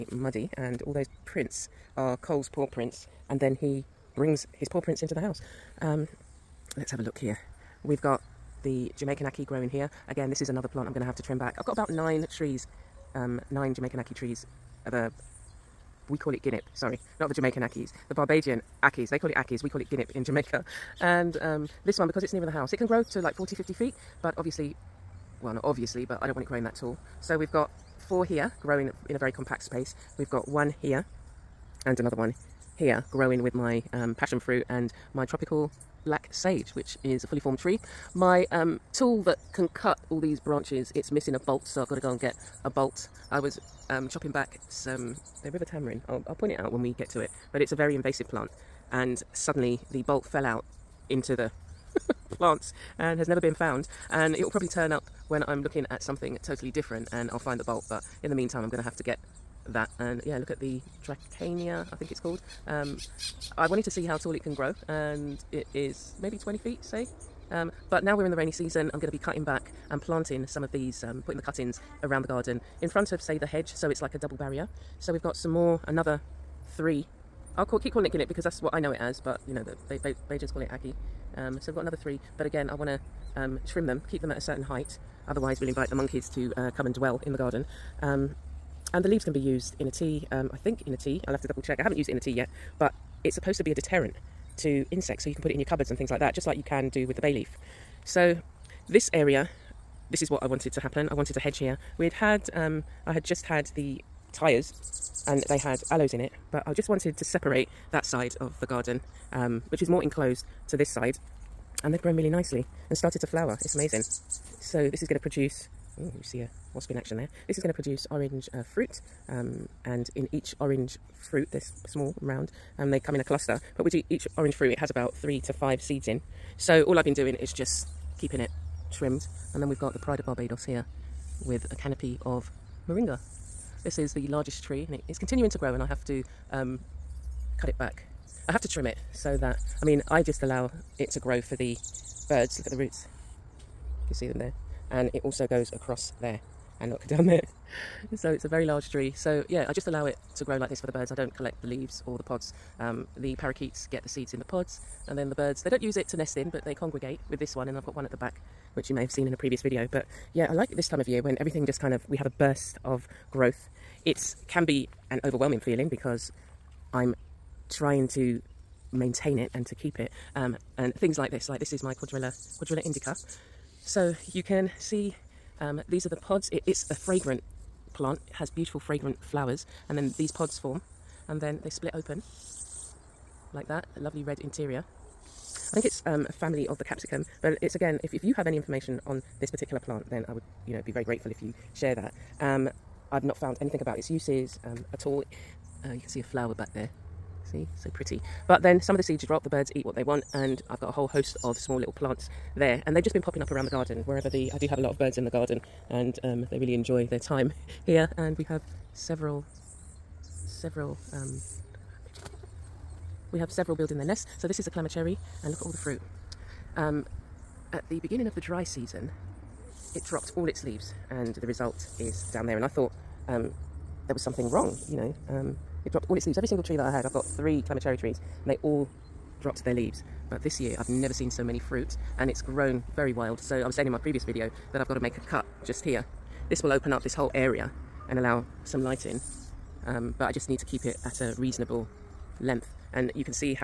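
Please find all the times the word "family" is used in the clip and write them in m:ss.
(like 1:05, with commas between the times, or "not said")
3:06.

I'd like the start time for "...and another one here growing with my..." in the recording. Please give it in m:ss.
0:31.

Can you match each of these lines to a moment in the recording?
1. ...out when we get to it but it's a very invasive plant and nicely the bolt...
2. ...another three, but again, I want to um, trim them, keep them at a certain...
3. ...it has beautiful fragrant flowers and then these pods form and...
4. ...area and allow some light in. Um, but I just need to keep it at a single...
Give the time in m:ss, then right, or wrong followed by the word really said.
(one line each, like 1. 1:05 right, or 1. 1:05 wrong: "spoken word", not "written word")
1. 0:46 wrong: "suddenly", not "nicely"
2. 1:21 right
3. 2:58 right
4. 3:57 wrong: "reasonable", not "single".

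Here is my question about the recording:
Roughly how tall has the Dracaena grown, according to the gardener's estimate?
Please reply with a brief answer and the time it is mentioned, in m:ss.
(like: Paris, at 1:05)
20 feet, at 1:06.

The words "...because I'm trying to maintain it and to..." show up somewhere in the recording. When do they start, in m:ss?
2:45.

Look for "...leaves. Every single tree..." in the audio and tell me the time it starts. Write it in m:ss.
3:46.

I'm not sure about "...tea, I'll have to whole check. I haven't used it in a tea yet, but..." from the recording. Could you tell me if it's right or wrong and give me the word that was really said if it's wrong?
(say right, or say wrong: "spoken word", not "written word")
wrong: "double", not "whole".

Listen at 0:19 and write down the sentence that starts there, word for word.
They call it Akis, we call it guinnip in Jamaica.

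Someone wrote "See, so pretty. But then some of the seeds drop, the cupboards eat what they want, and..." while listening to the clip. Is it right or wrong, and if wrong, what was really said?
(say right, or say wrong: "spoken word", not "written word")
wrong: "birds", not "cupboards".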